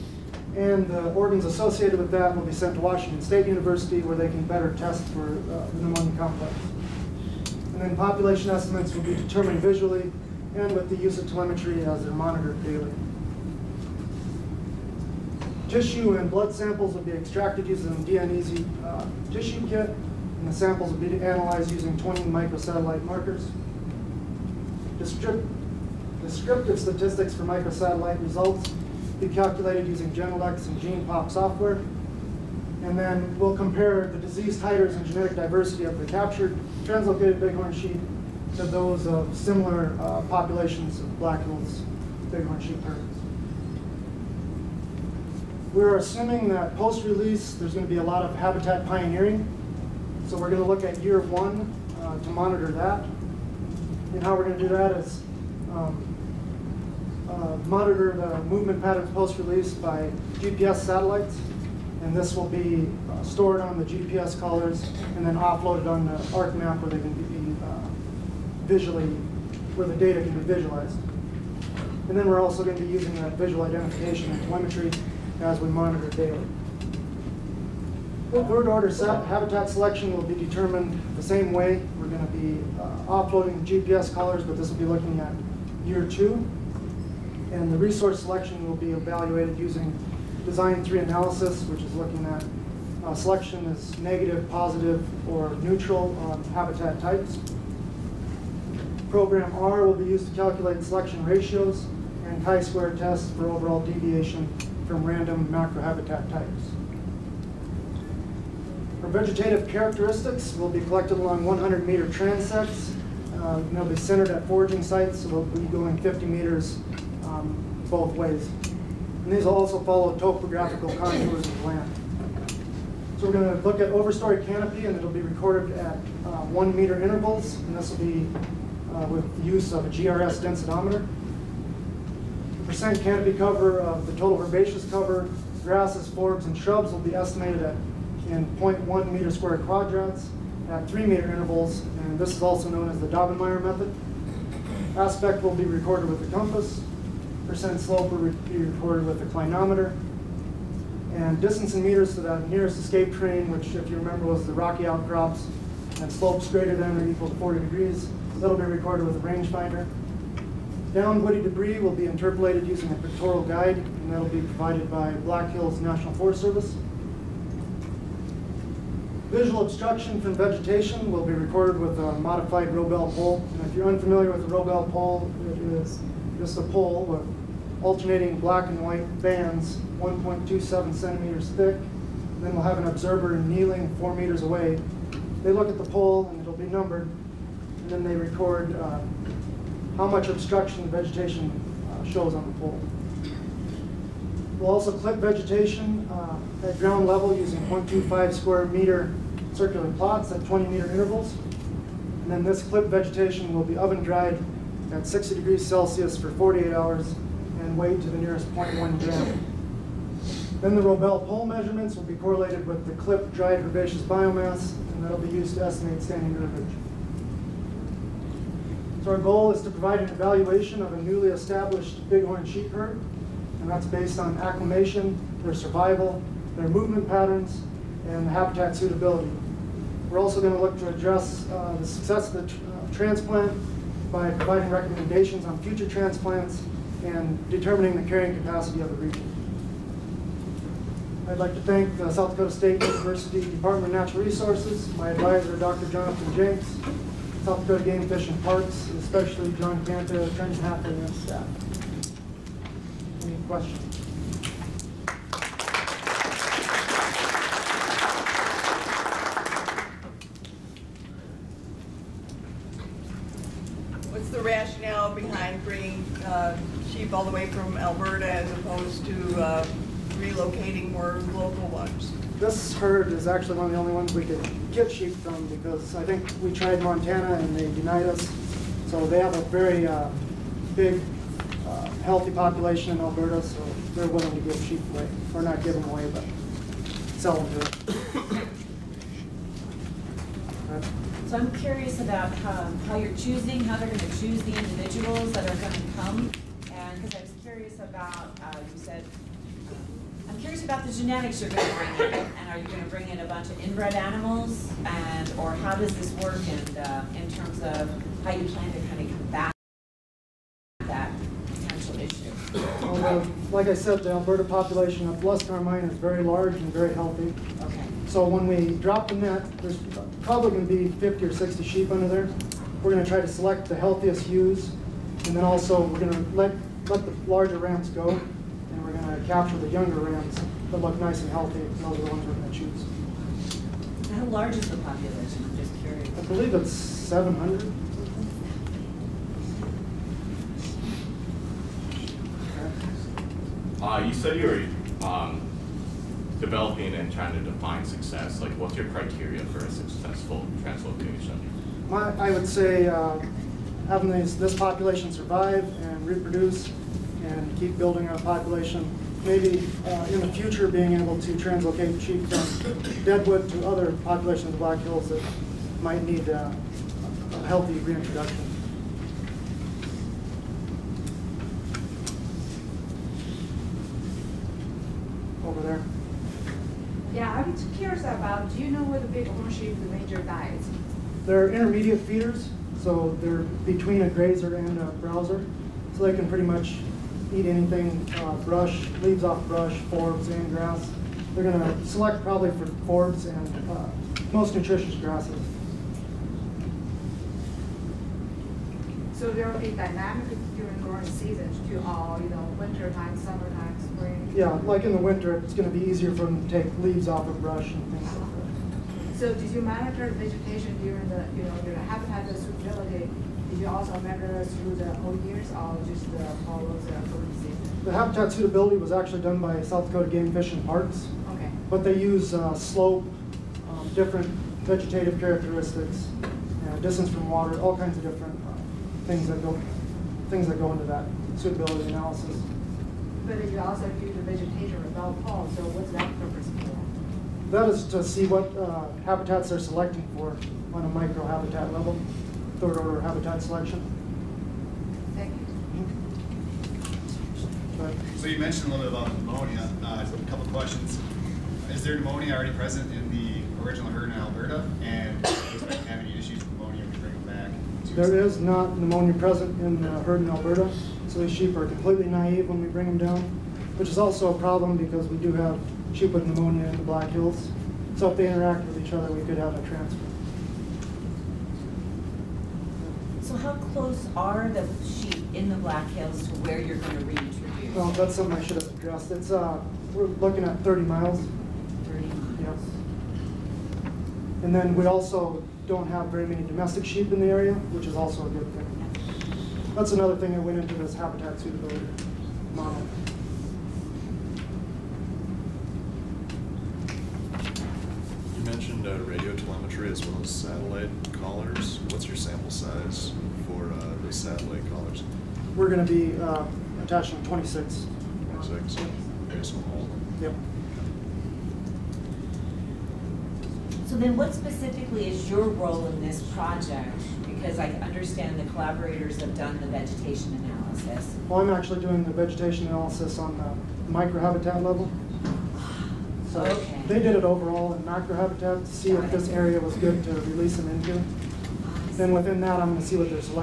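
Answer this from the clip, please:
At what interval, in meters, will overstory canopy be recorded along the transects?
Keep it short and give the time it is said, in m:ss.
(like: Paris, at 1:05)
1 meter, at 2:06.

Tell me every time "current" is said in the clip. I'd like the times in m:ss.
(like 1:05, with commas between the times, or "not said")
6:56.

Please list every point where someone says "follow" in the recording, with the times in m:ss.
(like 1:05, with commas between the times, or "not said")
1:59, 6:56.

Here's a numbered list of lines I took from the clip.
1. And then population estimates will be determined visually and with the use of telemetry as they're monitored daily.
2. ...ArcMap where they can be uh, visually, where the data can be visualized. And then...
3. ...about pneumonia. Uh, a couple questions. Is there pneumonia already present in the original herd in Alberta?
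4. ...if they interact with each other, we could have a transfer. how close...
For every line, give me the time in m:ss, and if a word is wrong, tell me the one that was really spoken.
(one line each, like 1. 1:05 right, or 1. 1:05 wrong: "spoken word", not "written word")
1. 0:07 right
2. 1:06 right
3. 7:29 right
4. 7:48 right.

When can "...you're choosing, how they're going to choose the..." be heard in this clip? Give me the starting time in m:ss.
4:52.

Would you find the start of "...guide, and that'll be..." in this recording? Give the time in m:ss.
2:43.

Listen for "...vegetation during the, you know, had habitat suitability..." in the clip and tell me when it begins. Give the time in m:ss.
6:50.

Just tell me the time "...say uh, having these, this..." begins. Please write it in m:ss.
5:52.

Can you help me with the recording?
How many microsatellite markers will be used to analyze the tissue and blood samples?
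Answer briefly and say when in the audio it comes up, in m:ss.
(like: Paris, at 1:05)
20, at 0:21.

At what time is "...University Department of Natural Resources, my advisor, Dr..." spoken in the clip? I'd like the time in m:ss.
4:02.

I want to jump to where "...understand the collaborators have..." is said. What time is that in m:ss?
8:37.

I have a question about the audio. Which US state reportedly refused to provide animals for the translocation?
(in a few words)
Montana.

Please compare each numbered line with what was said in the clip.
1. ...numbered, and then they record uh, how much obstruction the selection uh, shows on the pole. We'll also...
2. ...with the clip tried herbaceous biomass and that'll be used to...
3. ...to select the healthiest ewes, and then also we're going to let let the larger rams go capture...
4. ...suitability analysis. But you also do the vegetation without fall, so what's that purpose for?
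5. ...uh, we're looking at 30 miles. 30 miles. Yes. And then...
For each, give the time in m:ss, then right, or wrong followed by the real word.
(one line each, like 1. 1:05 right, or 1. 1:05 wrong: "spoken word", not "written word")
1. 3:06 wrong: "vegetation", not "selection"
2. 3:32 wrong: "dried", not "tried"
3. 5:23 right
4. 7:11 right
5. 7:59 right.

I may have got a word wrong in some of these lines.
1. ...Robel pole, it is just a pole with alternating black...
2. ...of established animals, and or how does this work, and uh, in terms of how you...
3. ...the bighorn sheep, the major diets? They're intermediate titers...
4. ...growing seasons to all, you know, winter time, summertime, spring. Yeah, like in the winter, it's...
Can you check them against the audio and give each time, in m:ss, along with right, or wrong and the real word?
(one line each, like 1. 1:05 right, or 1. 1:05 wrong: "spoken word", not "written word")
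1. 2:54 right
2. 5:03 wrong: "inbred", not "established"
3. 6:18 wrong: "feeders", not "titers"
4. 6:40 right.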